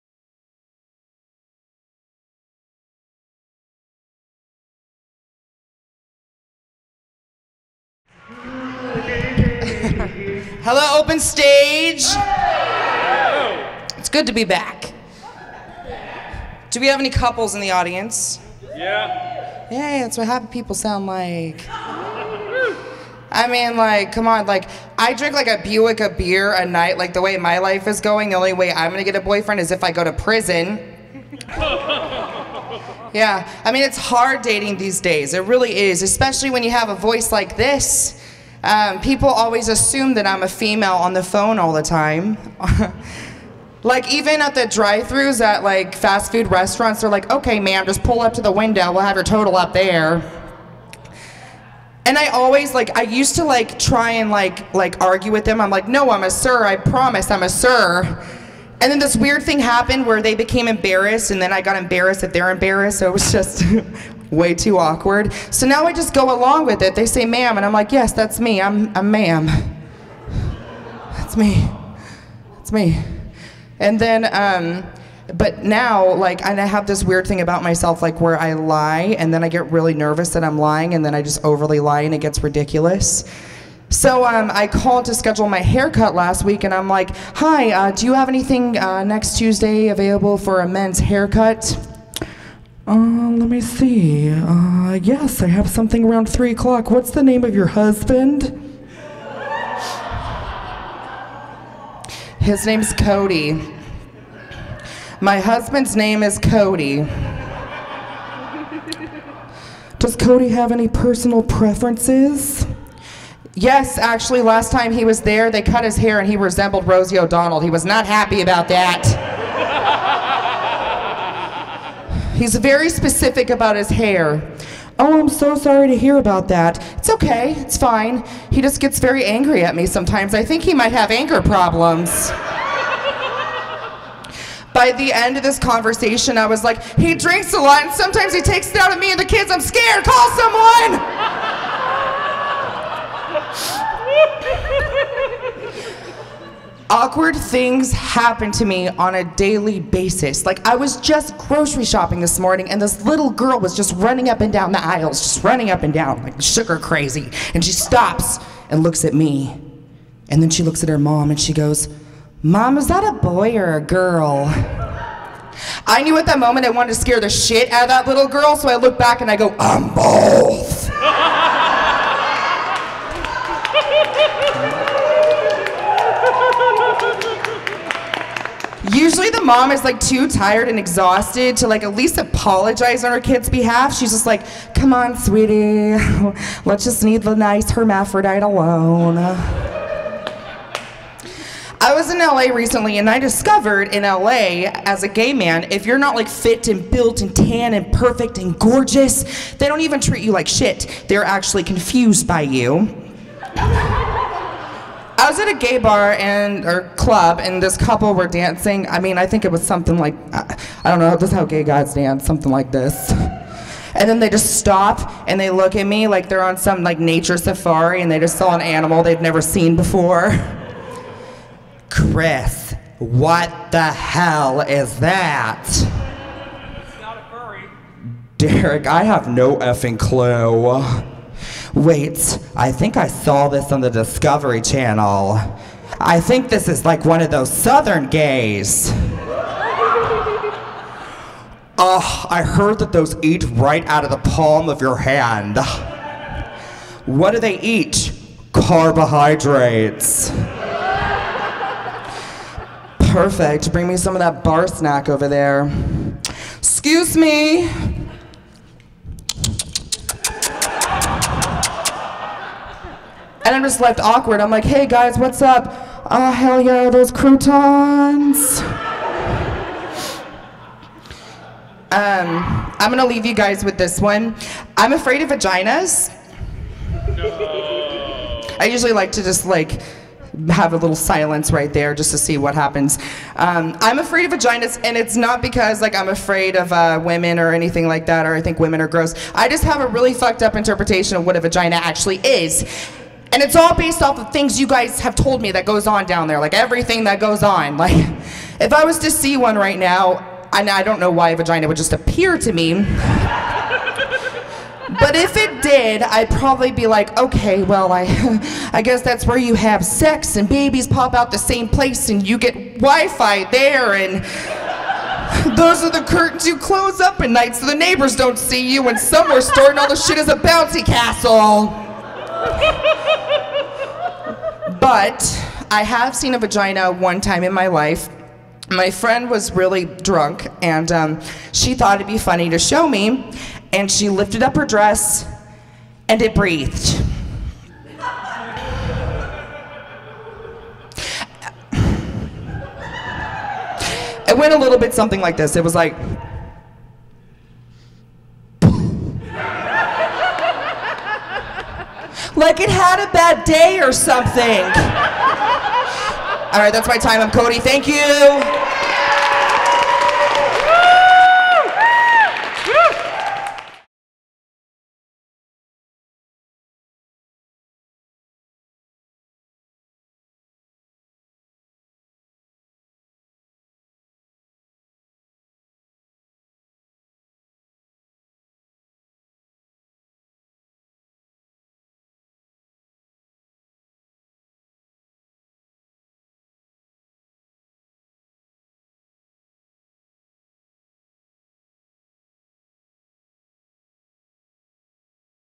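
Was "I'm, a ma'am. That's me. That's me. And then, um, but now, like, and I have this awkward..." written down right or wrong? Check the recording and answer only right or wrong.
wrong.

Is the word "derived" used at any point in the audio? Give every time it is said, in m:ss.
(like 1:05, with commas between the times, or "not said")
not said.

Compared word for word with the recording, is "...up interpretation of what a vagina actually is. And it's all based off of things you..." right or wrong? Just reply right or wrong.
right.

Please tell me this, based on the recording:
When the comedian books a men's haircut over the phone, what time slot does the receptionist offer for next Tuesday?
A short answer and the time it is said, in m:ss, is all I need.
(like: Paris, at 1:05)
3 o'clock, at 1:36.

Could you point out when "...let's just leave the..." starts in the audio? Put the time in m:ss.
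3:06.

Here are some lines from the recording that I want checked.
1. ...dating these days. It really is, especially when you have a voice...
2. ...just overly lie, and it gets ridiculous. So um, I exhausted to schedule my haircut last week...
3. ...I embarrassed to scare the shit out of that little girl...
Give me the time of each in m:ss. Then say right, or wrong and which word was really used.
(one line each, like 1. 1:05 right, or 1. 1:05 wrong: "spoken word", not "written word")
1. 0:34 right
2. 1:21 wrong: "called", not "exhausted"
3. 2:46 wrong: "wanted", not "embarrassed".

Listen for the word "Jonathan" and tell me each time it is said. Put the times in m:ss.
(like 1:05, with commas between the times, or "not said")
not said.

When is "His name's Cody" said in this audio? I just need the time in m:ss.
1:42.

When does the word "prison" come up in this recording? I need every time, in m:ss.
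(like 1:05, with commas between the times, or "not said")
0:30.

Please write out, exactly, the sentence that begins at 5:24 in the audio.
But I have seen a vagina one time in my life.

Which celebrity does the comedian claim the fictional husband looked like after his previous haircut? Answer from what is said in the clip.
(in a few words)
Rosie O'Donnell.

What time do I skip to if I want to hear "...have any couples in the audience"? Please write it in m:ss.
0:16.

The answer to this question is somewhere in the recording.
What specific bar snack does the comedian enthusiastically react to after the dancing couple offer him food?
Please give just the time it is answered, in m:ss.
4:27.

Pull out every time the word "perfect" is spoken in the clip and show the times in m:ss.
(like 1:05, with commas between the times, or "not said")
3:17, 4:13.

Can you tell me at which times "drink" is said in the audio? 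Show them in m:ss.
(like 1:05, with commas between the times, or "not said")
0:25, 2:17.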